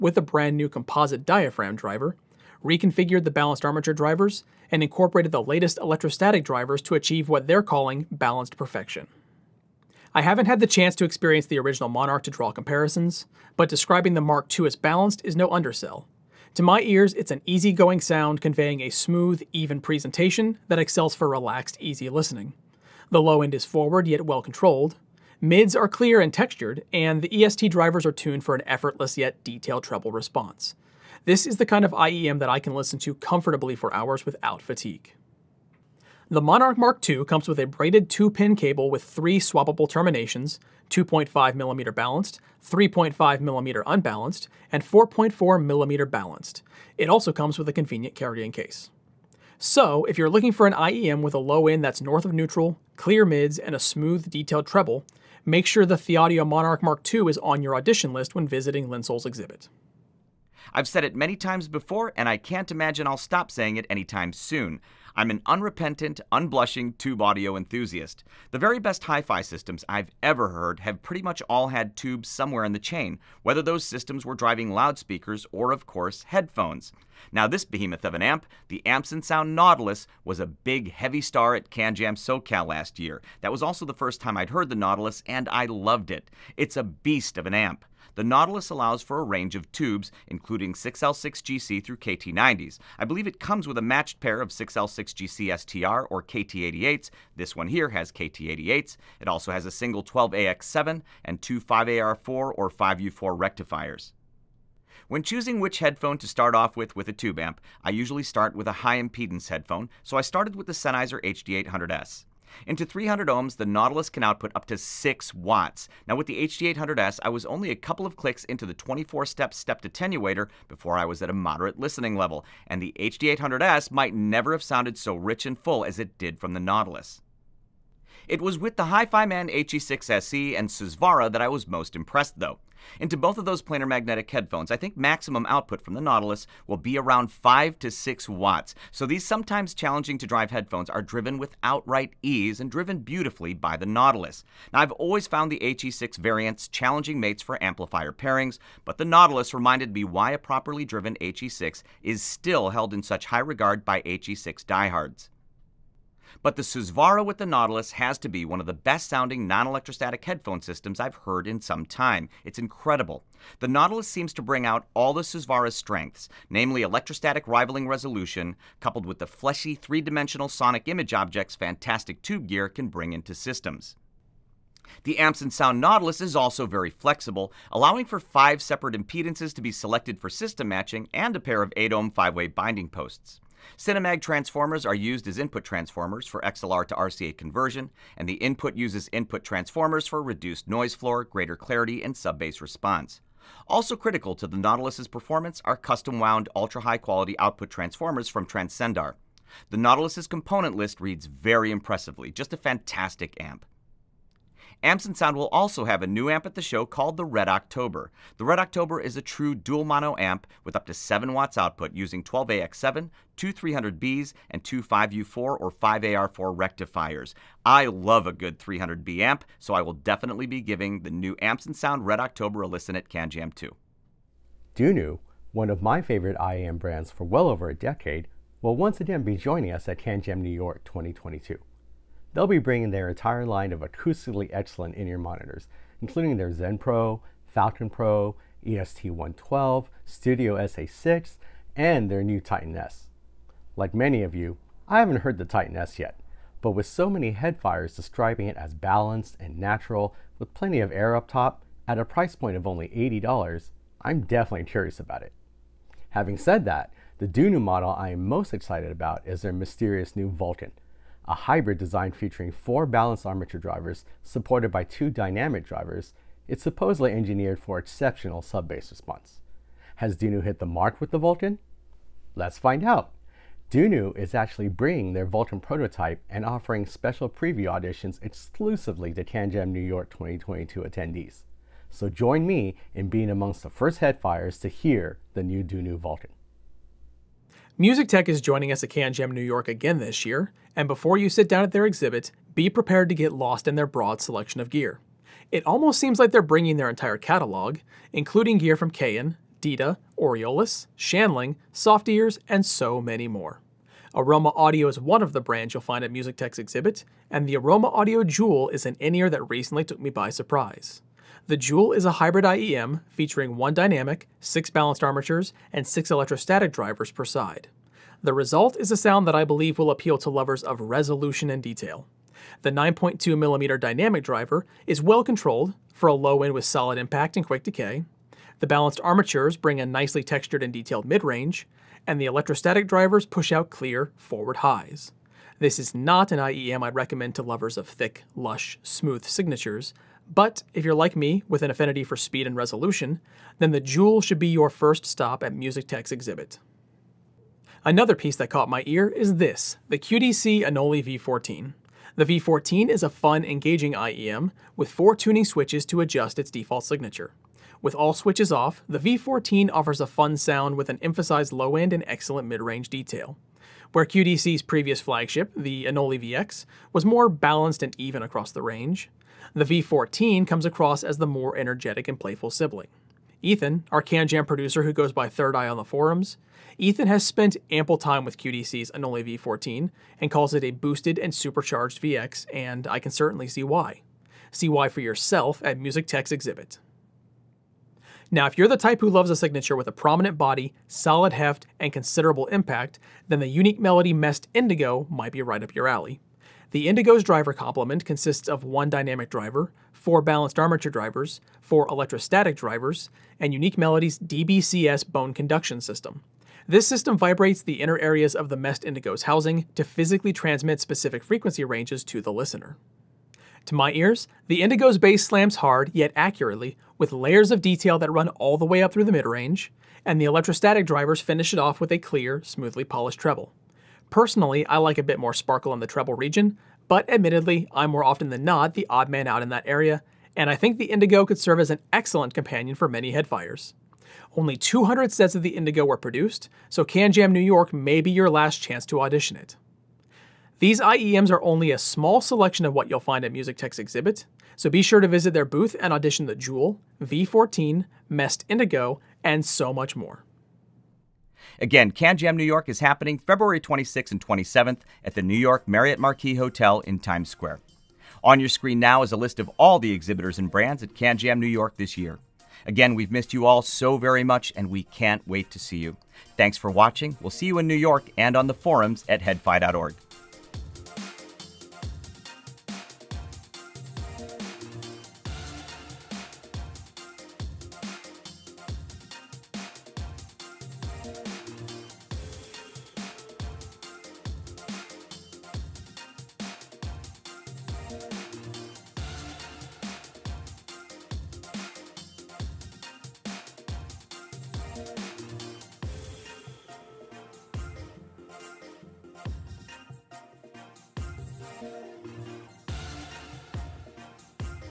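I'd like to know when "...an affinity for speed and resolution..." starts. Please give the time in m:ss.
5:41.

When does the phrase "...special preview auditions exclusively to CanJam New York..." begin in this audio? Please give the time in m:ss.
4:36.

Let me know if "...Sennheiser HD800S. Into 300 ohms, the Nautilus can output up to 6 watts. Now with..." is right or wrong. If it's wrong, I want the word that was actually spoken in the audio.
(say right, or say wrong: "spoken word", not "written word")
right.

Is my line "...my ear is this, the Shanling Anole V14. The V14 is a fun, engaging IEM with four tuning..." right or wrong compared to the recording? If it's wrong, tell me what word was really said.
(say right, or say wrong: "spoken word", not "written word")
wrong: "QDC", not "Shanling".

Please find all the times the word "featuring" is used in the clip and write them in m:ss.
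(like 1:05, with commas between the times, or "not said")
4:22, 5:13.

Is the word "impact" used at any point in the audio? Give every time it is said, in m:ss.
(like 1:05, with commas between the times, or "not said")
5:26, 6:32.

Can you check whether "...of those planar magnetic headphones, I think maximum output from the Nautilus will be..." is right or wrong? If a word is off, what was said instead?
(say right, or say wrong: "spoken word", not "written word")
right.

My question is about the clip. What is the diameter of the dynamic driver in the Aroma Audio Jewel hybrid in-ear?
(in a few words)
9.2mm.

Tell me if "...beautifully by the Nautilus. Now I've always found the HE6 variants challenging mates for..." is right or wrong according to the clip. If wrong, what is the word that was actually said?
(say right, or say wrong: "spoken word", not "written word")
right.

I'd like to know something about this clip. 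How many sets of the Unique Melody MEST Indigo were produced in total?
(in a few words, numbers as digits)
200.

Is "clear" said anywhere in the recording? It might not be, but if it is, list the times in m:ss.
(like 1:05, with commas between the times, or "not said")
0:25, 0:52, 5:33, 7:01.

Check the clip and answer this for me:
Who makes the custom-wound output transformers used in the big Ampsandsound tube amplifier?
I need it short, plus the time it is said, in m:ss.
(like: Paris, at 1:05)
Transcendar, at 3:18.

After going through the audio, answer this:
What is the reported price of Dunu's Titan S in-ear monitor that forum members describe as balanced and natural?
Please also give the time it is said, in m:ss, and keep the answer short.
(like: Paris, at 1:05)
$80, at 4:12.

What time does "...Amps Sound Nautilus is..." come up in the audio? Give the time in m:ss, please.
2:55.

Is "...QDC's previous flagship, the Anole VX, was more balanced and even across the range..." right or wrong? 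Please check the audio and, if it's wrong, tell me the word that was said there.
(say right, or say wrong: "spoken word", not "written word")
right.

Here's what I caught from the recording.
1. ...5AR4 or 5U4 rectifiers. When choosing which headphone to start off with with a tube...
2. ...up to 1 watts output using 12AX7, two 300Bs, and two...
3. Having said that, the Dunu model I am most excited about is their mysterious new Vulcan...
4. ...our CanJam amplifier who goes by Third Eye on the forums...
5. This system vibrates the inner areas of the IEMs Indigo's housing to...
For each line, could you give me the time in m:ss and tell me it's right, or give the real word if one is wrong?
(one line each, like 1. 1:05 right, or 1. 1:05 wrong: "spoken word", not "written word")
1. 1:41 right
2. 3:30 wrong: "7", not "1"
3. 4:16 right
4. 6:13 wrong: "producer", not "amplifier"
5. 6:46 wrong: "MEST", not "IEMs".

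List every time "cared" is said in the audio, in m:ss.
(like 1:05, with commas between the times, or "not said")
not said.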